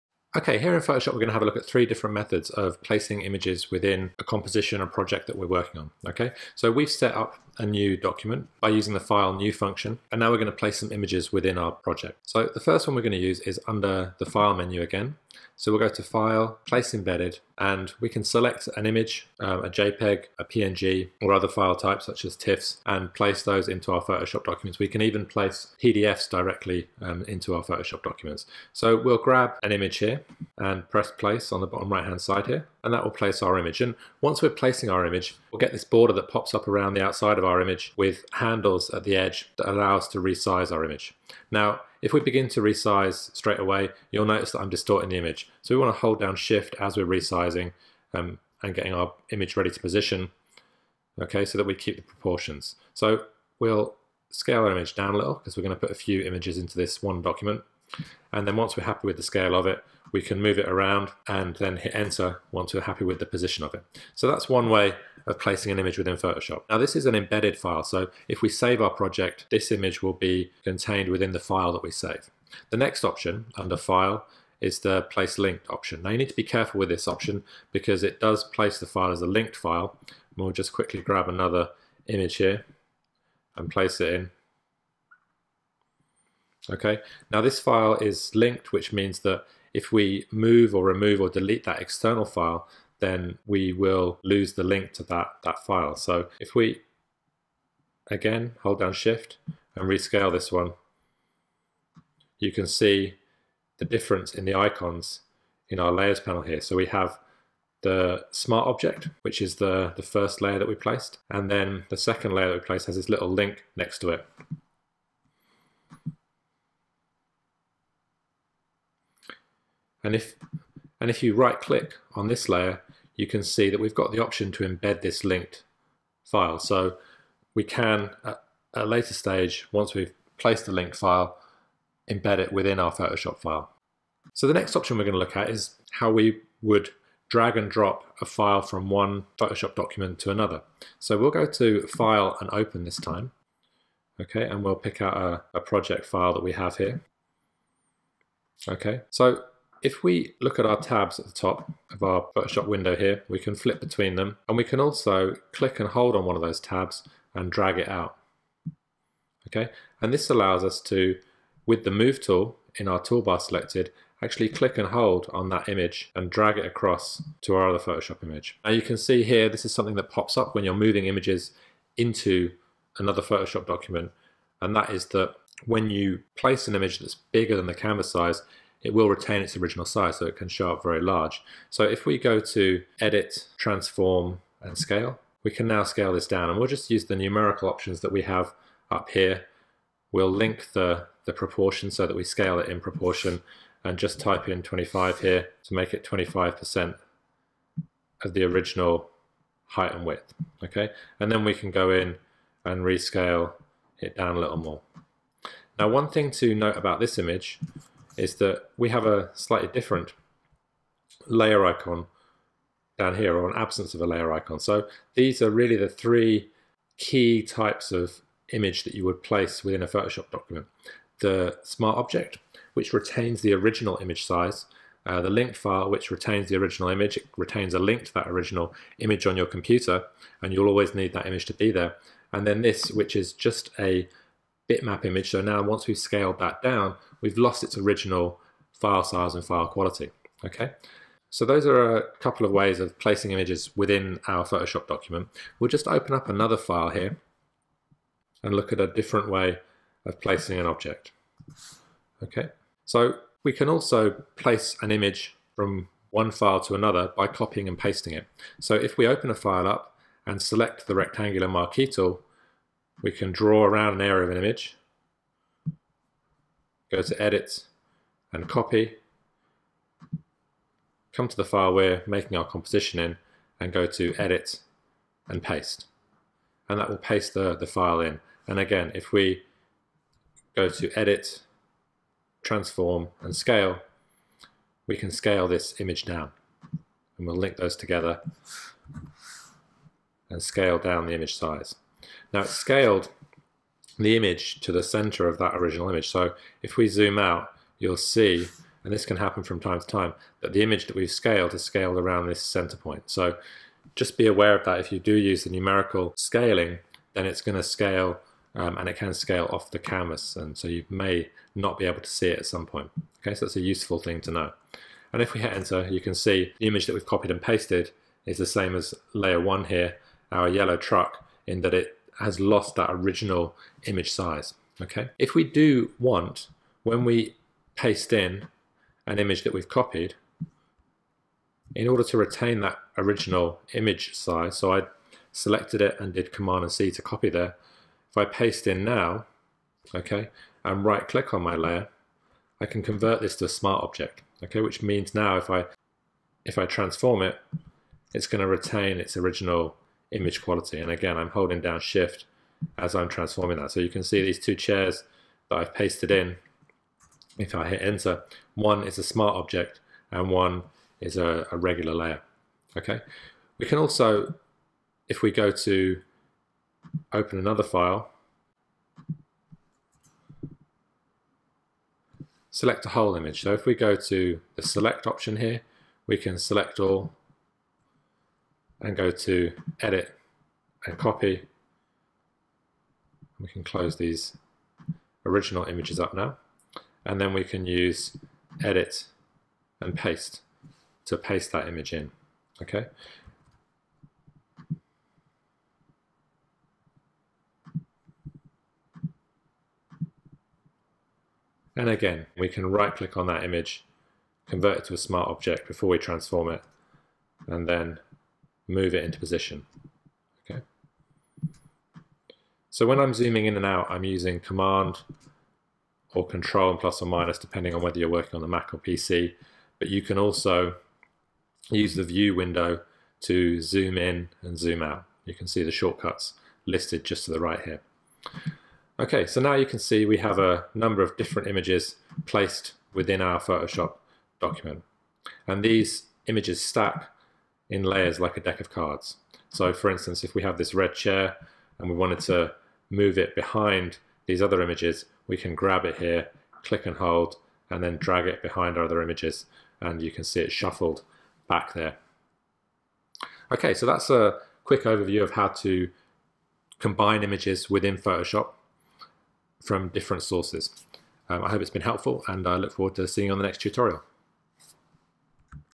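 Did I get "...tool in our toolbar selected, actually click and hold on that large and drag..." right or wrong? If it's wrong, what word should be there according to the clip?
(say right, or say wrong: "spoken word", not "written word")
wrong: "image", not "large".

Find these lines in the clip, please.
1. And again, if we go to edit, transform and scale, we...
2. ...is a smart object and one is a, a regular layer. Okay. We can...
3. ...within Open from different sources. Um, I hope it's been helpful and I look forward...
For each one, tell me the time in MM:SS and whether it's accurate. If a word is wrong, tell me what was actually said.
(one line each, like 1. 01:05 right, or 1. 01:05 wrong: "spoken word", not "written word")
1. 04:38 right
2. 05:58 right
3. 07:37 wrong: "Photoshop", not "Open".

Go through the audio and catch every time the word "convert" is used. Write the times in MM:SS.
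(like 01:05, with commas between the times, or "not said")
05:42, 06:44.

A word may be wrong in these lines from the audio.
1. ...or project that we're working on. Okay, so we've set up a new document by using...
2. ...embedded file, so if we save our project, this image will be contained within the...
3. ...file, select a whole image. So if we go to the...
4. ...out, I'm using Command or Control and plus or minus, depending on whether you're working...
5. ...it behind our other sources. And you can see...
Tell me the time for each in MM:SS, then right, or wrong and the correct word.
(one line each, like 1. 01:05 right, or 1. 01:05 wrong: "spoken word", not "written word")
1. 00:04 right
2. 01:07 right
3. 06:07 right
4. 06:53 right
5. 07:28 wrong: "images", not "sources".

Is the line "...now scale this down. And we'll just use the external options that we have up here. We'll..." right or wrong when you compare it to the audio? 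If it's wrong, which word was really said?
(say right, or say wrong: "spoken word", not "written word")
wrong: "numerical", not "external".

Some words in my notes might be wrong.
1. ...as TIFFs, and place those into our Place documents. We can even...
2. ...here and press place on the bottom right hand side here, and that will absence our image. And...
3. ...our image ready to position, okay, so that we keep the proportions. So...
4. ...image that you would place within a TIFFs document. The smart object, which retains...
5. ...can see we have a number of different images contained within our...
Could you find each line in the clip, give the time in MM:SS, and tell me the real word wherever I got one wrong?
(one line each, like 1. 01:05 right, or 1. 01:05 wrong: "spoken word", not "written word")
1. 00:22 wrong: "Photoshop", not "Place"
2. 00:29 wrong: "place", not "absence"
3. 00:48 right
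4. 03:38 wrong: "Photoshop", not "TIFFs"
5. 07:09 wrong: "placed", not "contained".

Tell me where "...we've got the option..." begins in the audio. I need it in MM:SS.
02:03.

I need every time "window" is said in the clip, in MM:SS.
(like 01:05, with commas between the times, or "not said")
02:32, 07:02.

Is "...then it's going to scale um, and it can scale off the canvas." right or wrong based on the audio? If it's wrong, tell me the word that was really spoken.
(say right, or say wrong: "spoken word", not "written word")
right.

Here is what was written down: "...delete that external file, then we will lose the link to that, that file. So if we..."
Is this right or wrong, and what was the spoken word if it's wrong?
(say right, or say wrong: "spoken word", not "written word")
right.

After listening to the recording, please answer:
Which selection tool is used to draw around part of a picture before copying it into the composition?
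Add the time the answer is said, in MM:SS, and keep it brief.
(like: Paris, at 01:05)
Rectangular marquee tool, at 04:20.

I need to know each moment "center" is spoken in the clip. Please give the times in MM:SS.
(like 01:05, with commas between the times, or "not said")
04:54, 05:02.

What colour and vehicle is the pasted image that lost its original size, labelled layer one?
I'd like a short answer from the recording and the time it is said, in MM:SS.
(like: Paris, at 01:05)
Yellow truck, at 05:20.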